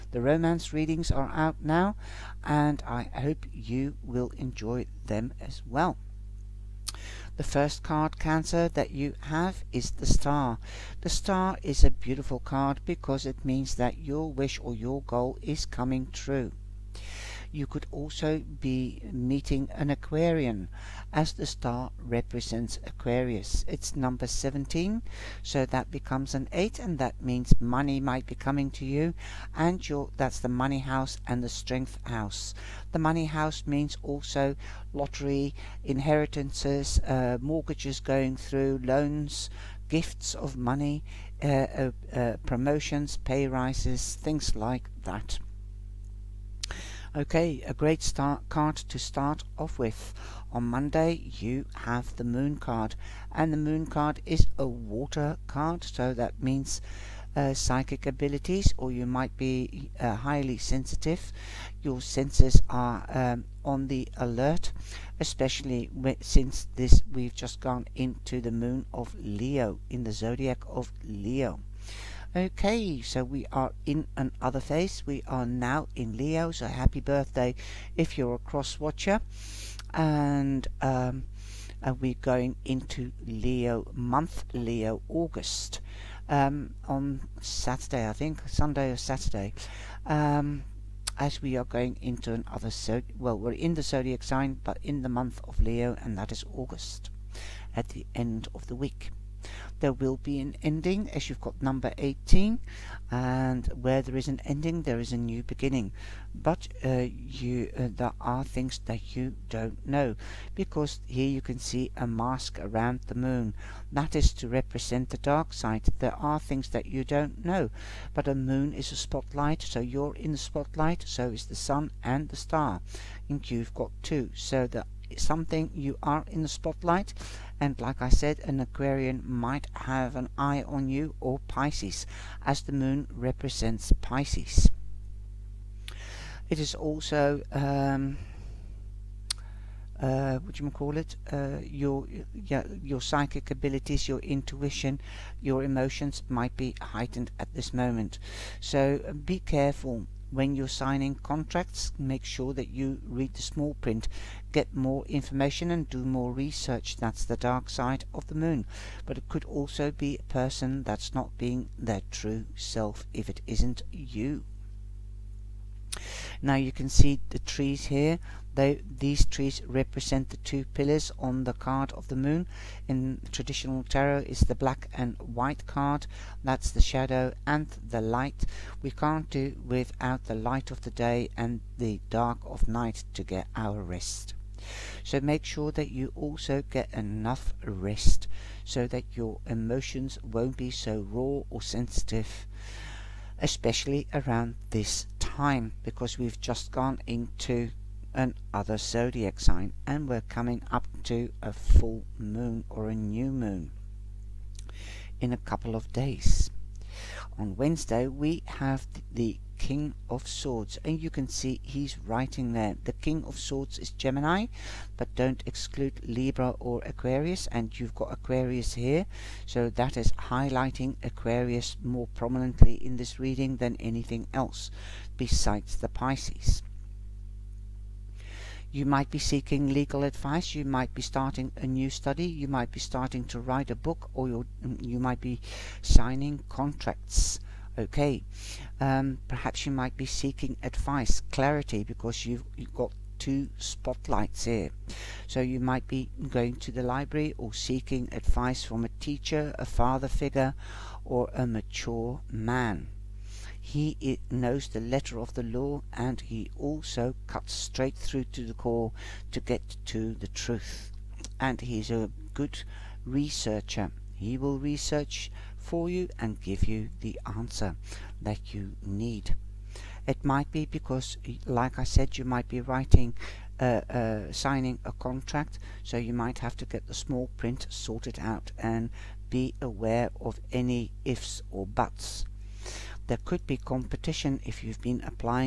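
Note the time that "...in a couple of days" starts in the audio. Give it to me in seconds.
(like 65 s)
205 s.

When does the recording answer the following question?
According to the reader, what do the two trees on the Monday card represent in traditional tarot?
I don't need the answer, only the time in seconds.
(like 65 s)
170 s.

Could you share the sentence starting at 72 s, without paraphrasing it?
Okay, so we are in another phase.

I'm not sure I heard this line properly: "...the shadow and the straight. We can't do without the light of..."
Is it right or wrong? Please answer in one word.
wrong.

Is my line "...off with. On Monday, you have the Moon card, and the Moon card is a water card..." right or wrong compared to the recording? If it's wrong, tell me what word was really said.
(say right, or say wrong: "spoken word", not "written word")
right.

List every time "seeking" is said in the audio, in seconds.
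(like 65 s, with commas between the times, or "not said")
229 s, 240 s, 247 s.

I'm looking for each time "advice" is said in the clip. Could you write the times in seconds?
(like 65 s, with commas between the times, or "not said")
230 s, 240 s, 248 s.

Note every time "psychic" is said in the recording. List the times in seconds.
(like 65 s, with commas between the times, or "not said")
57 s, 142 s.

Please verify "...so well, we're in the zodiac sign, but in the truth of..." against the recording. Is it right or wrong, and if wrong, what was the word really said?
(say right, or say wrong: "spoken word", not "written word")
wrong: "month", not "truth".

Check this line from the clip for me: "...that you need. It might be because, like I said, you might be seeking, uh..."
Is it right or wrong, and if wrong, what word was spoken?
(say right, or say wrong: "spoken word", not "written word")
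wrong: "writing", not "seeking".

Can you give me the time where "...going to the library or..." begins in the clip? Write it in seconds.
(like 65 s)
246 s.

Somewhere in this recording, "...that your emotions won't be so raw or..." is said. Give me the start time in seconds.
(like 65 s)
188 s.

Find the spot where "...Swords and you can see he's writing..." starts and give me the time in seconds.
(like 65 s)
210 s.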